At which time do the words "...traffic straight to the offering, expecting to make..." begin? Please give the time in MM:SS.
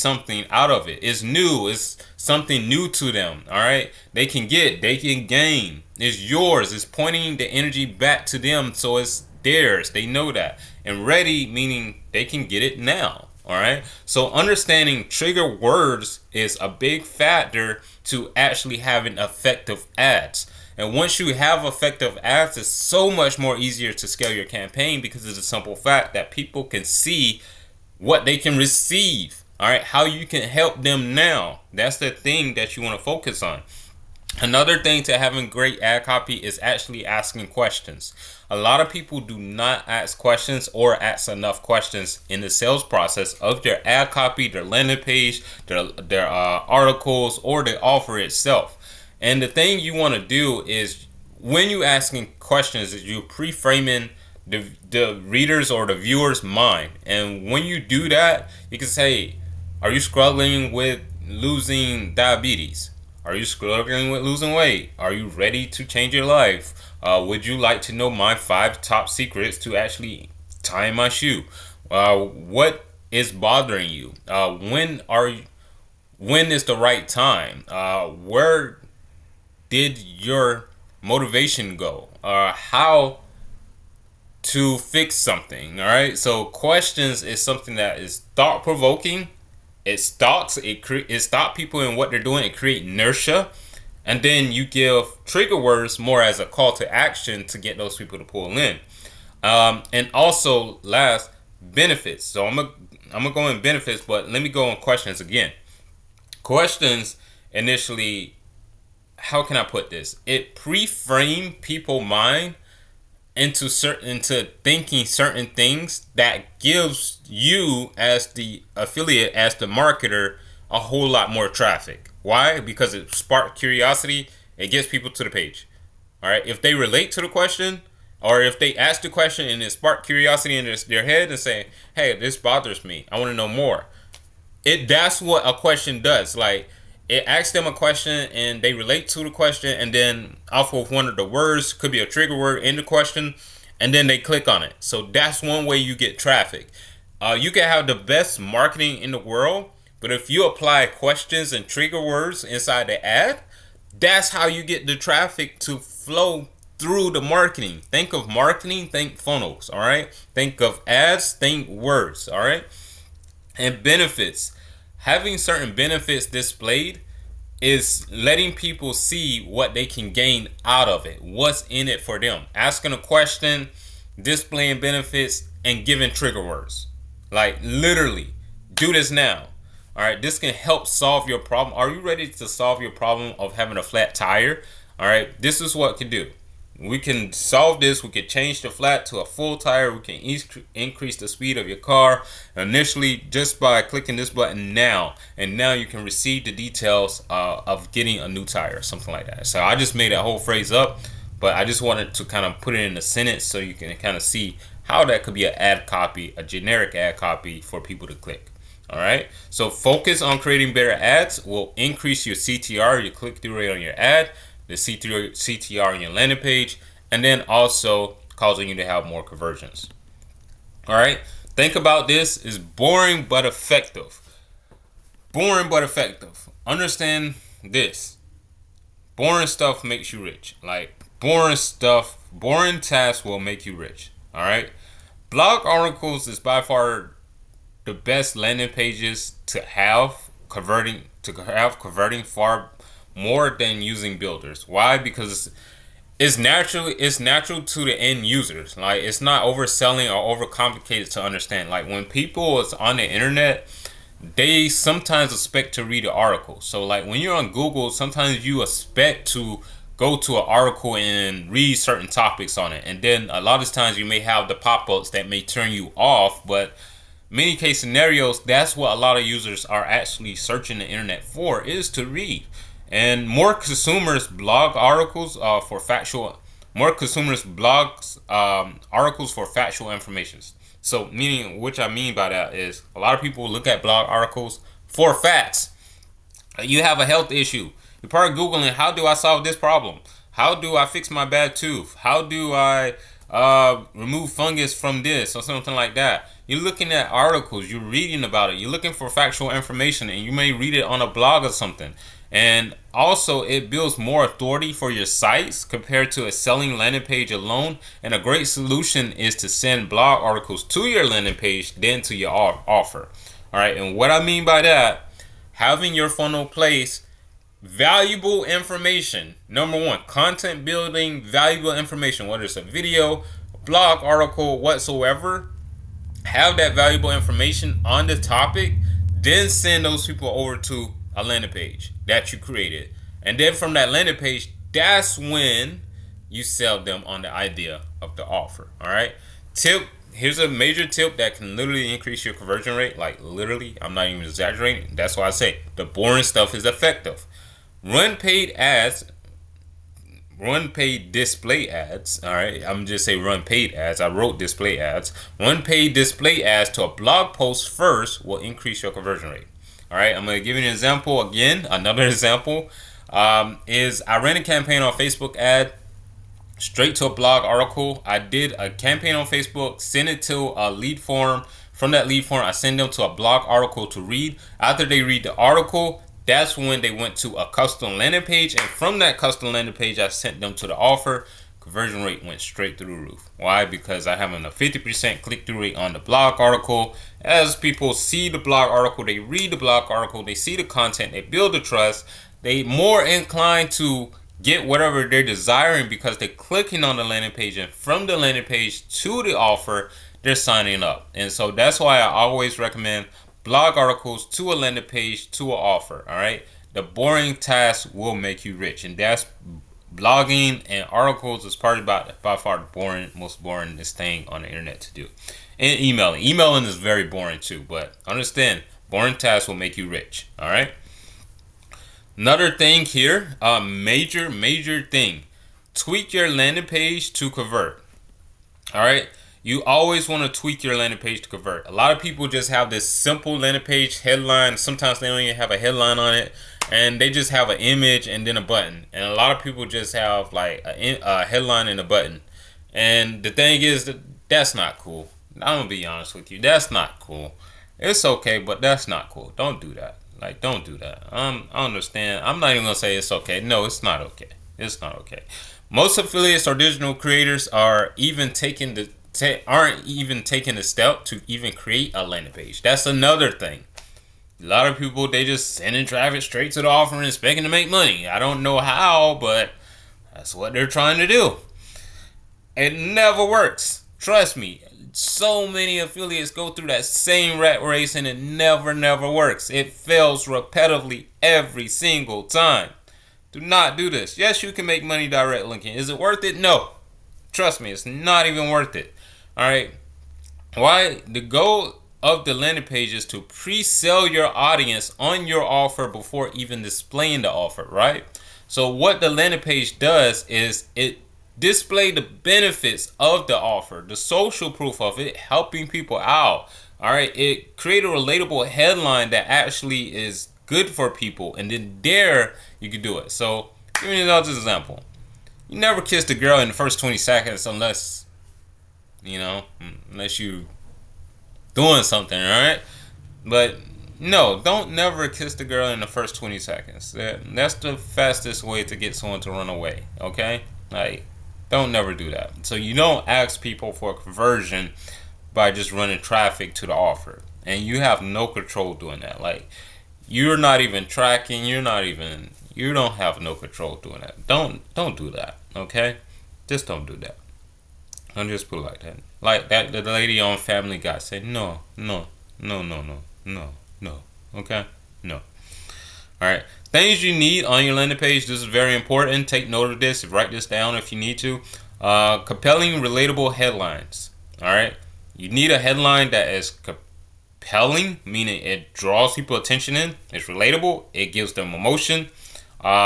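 07:45.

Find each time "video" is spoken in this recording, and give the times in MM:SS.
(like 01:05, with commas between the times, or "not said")
05:22.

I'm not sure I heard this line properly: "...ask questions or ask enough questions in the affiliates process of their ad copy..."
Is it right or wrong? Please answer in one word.
wrong.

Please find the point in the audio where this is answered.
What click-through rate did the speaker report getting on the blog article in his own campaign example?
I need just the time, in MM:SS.
06:24.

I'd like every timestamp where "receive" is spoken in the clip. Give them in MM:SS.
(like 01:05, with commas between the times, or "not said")
00:28, 03:16.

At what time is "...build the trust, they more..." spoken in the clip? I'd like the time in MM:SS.
06:31.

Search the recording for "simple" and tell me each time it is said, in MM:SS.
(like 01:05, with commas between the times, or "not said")
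00:25, 07:12.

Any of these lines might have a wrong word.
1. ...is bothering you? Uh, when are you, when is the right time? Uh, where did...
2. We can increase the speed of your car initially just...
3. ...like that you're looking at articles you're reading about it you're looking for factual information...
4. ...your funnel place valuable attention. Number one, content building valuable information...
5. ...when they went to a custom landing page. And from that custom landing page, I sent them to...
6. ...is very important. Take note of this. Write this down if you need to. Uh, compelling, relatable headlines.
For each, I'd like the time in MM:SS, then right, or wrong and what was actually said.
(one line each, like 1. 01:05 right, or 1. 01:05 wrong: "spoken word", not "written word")
1. 01:13 right
2. 03:09 right
3. 04:55 right
4. 05:15 wrong: "information", not "attention"
5. 06:16 right
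6. 09:18 right.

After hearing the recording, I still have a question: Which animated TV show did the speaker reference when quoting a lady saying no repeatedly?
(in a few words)
Family Guy.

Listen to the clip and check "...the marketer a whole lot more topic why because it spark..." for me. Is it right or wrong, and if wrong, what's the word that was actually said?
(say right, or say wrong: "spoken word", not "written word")
wrong: "traffic", not "topic".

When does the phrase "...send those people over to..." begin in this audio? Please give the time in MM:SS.
05:29.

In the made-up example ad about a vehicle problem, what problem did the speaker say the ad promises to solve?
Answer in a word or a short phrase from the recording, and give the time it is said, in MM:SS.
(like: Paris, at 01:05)
flat tire, at 03:03.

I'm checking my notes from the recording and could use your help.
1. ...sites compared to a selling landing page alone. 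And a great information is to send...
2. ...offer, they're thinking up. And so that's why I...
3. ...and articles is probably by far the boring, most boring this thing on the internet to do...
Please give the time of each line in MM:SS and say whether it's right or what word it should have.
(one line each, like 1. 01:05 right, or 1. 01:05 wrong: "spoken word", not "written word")
1. 05:05 wrong: "solution", not "information"
2. 06:39 wrong: "signing", not "thinking"
3. 06:50 right.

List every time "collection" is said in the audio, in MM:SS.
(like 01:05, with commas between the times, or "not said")
not said.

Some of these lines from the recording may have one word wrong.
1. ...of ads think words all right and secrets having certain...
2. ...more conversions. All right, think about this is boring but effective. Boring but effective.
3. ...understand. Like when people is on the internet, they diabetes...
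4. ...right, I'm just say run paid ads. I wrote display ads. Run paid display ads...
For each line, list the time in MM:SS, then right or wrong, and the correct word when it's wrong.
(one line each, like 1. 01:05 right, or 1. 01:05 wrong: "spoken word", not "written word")
1. 02:40 wrong: "benefits", not "secrets"
2. 03:39 right
3. 04:11 wrong: "sometimes", not "diabetes"
4. 05:52 right.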